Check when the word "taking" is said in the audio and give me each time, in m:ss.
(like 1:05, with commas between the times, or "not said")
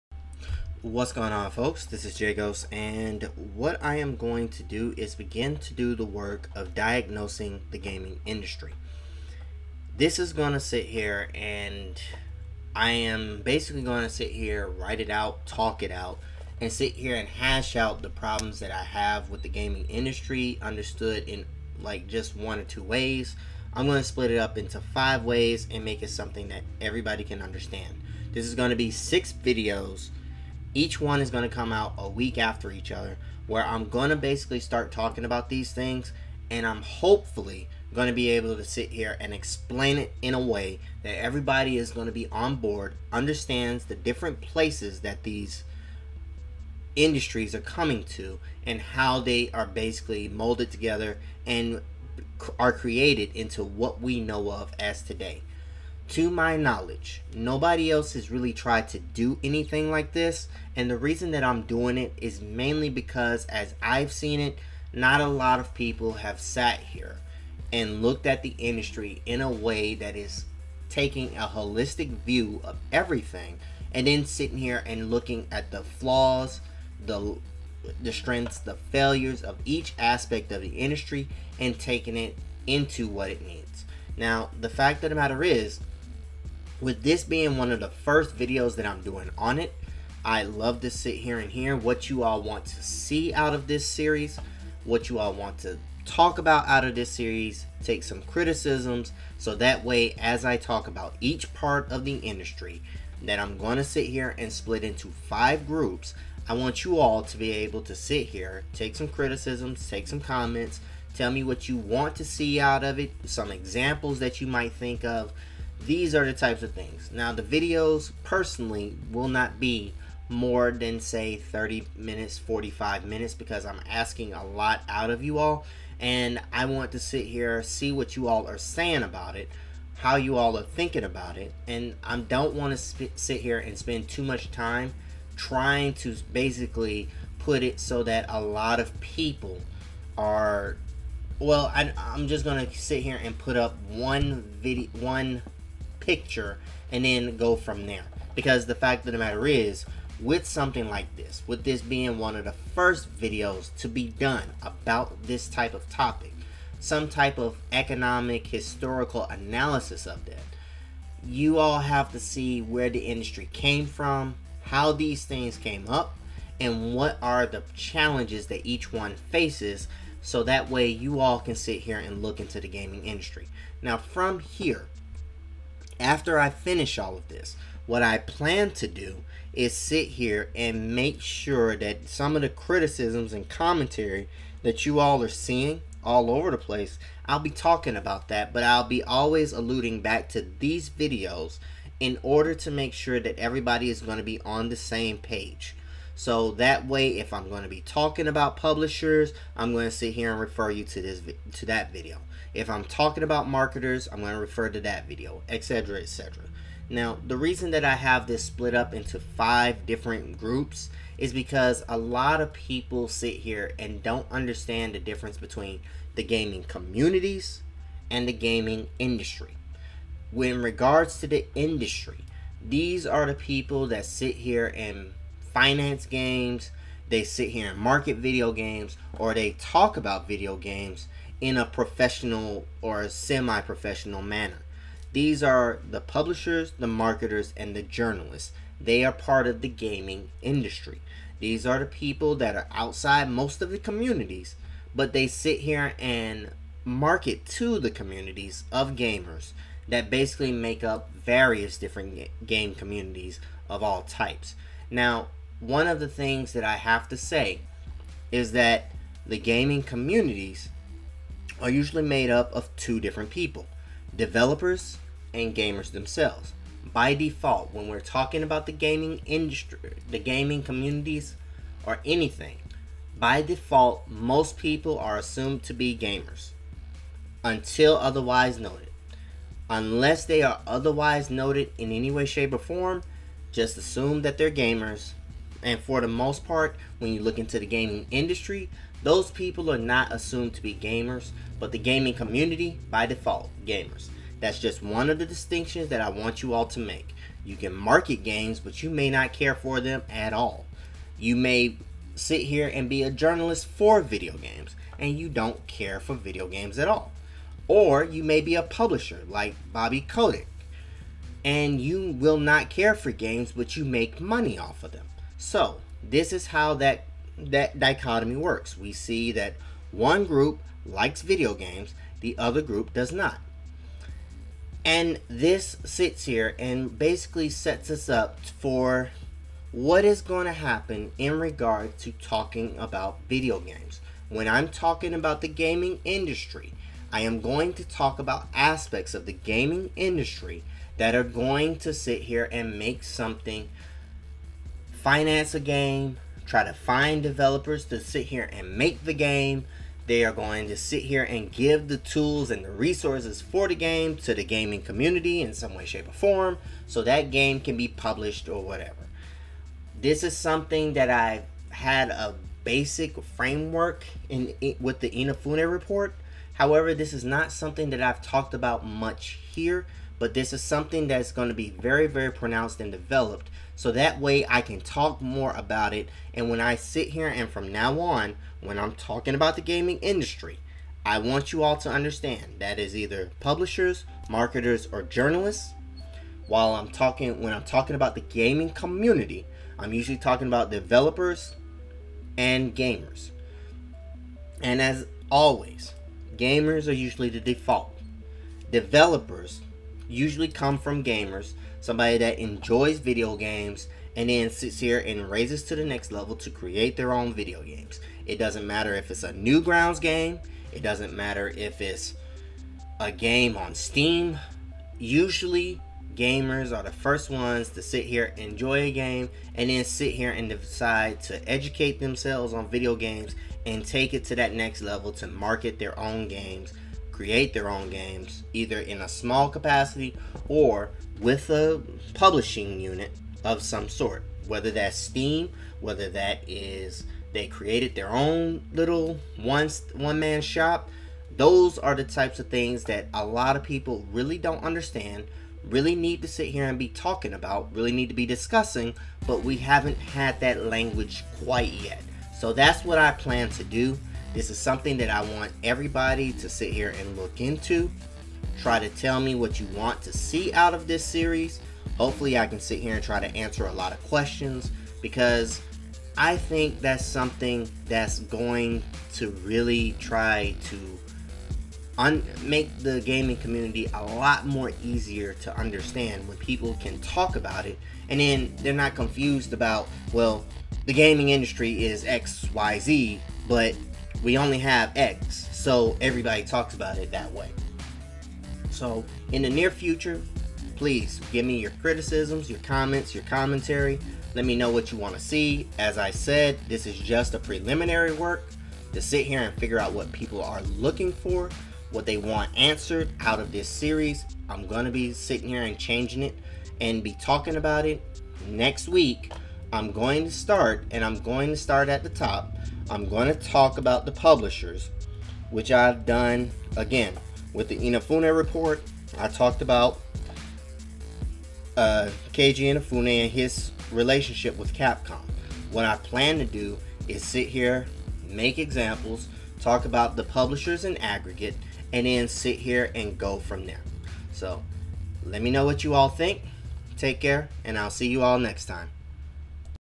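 1:10, 1:21.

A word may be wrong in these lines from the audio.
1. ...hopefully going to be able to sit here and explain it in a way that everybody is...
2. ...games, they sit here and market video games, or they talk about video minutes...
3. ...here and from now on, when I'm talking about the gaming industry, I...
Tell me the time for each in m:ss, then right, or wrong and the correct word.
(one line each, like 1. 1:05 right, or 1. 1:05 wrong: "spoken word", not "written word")
1. 0:36 right
2. 3:46 wrong: "games", not "minutes"
3. 6:17 right.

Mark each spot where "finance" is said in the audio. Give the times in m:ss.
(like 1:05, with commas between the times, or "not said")
3:45, 5:45.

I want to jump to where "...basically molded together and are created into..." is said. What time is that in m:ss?
0:49.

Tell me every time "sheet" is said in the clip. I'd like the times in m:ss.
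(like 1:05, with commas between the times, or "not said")
not said.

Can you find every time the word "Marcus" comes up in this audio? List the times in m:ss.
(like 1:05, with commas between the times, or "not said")
not said.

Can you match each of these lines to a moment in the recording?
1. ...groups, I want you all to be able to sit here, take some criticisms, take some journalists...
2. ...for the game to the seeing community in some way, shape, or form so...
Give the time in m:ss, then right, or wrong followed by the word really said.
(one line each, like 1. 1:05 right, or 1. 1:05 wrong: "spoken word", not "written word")
1. 1:45 wrong: "comments", not "journalists"
2. 5:53 wrong: "gaming", not "seeing".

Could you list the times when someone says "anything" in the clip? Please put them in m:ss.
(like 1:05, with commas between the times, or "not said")
0:59, 4:32.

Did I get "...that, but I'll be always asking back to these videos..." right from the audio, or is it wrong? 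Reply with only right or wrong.
wrong.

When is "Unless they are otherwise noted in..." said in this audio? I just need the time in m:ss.
4:39.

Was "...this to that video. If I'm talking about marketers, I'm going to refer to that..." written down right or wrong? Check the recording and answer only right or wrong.
right.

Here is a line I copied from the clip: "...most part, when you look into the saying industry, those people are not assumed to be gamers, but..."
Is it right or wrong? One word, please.
wrong.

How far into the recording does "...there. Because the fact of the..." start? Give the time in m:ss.
2:27.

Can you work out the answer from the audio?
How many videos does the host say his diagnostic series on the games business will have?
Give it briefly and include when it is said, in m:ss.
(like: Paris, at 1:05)
6, at 0:28.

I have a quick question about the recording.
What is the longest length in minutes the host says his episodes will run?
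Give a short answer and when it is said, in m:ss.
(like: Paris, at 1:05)
45 minutes, at 2:02.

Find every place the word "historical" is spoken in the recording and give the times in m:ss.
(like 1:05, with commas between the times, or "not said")
2:38.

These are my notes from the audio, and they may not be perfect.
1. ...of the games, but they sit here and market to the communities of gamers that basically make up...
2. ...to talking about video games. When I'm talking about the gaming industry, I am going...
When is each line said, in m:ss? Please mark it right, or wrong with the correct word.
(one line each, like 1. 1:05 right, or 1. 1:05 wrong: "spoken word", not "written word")
1. 4:03 wrong: "communities", not "games"
2. 5:31 right.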